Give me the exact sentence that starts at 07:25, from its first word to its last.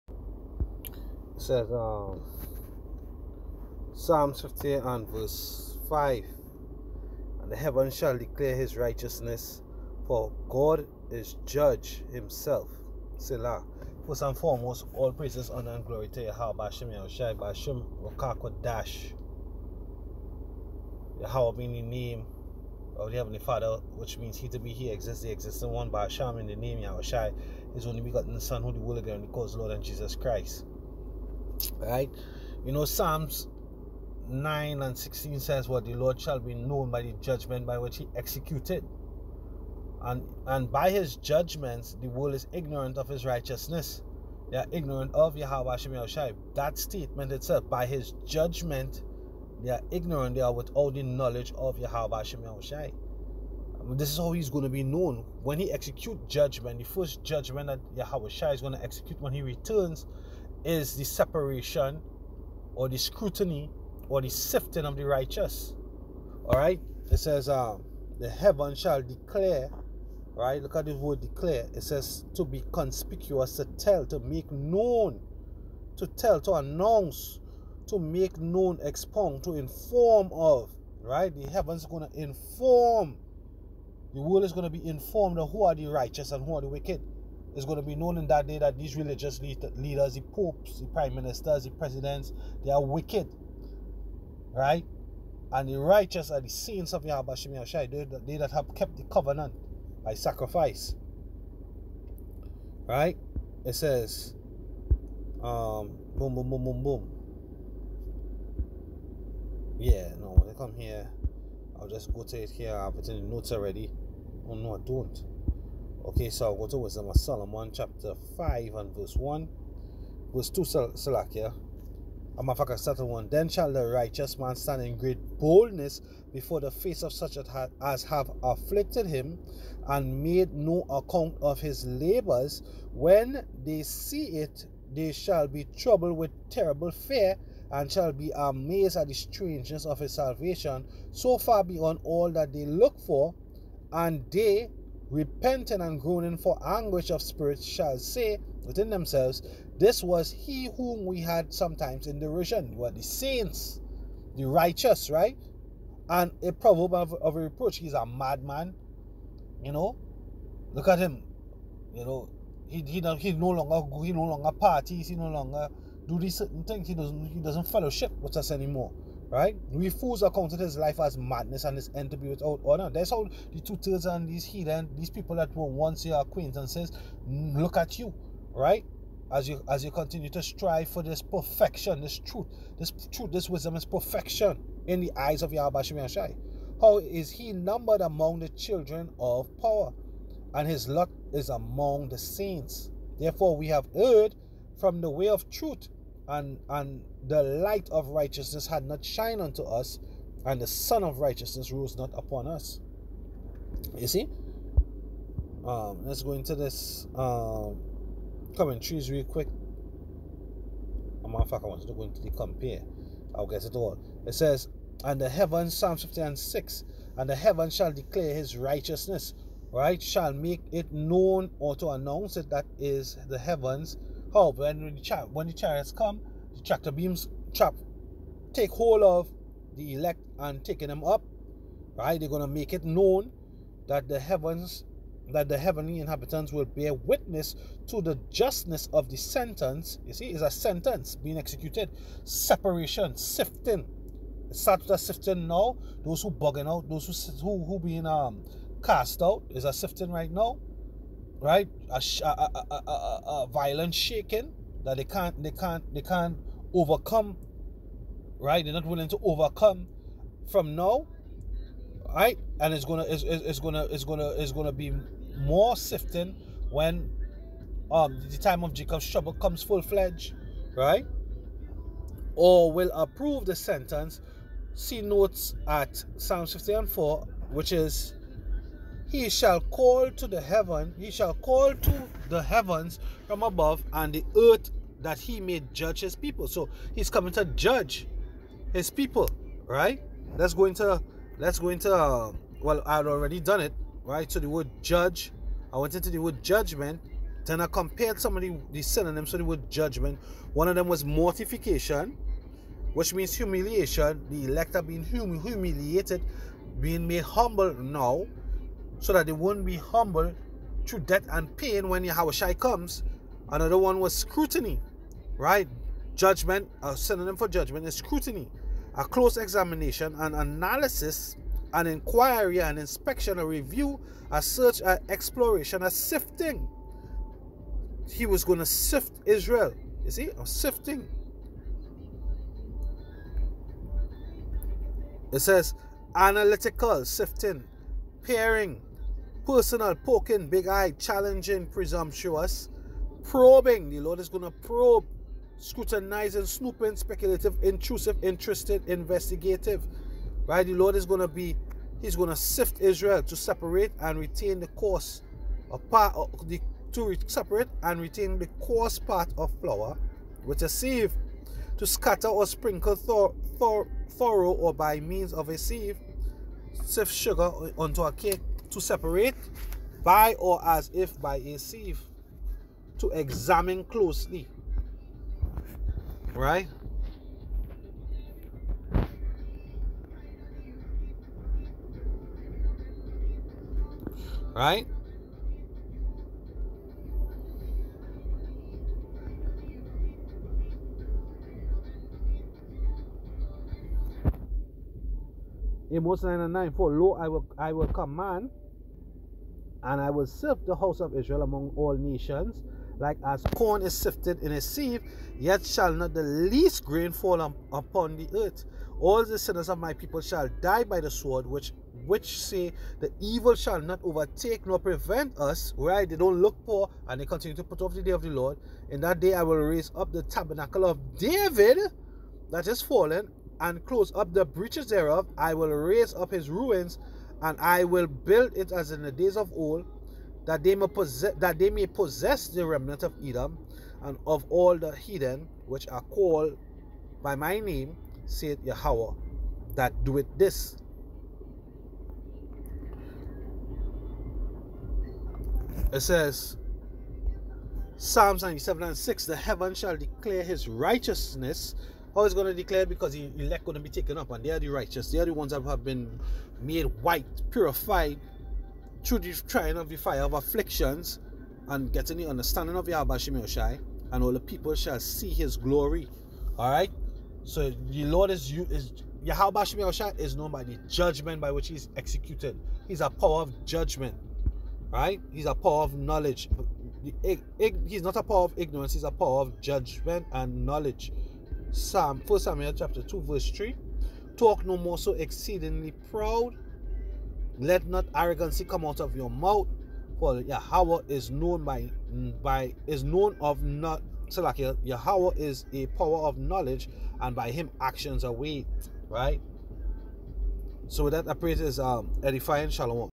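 It says, Psalms 97 and 6, the heaven shall declare his righteousness.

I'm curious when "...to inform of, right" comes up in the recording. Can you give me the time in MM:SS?
01:19.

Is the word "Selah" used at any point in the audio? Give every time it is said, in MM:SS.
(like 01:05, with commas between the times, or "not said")
00:13.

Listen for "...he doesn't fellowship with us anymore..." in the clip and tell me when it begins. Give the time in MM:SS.
02:47.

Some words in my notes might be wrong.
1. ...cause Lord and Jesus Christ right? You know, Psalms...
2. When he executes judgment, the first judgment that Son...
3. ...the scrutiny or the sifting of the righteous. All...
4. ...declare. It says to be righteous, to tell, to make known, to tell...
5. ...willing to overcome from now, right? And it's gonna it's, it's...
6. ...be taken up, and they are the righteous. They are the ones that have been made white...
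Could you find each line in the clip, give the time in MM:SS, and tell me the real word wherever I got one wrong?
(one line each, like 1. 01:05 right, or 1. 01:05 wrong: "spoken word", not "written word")
1. 00:29 right
2. 00:55 wrong: "Yahweh", not "Son"
3. 01:02 right
4. 01:11 wrong: "conspicuous", not "righteous"
5. 04:18 right
6. 07:33 right.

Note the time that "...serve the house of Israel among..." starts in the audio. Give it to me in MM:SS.
06:40.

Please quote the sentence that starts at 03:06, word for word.
How is he numbered among the children of power?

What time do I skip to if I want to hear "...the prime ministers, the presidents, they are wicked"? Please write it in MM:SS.
01:30.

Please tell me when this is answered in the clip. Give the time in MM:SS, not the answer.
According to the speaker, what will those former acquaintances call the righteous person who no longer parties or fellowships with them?
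02:37.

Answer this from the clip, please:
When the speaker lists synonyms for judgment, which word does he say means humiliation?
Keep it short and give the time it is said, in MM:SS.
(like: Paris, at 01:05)
Mortification, at 05:01.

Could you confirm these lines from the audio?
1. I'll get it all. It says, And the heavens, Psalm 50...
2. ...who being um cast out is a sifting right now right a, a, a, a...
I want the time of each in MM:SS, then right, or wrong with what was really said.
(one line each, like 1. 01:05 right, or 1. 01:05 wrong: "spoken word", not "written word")
1. 03:33 right
2. 04:07 right.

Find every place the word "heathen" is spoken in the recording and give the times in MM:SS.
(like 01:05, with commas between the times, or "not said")
02:54, 07:14.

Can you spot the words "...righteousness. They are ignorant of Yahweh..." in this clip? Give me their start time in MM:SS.
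00:43.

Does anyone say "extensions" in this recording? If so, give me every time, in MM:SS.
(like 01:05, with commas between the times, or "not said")
not said.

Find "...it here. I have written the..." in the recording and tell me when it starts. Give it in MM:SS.
01:52.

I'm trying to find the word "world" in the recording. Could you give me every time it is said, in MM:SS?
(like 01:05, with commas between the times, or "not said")
00:42, 01:24.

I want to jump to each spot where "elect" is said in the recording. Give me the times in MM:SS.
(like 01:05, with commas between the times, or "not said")
03:49, 05:04, 07:33.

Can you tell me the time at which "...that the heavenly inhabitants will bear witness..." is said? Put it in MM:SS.
03:55.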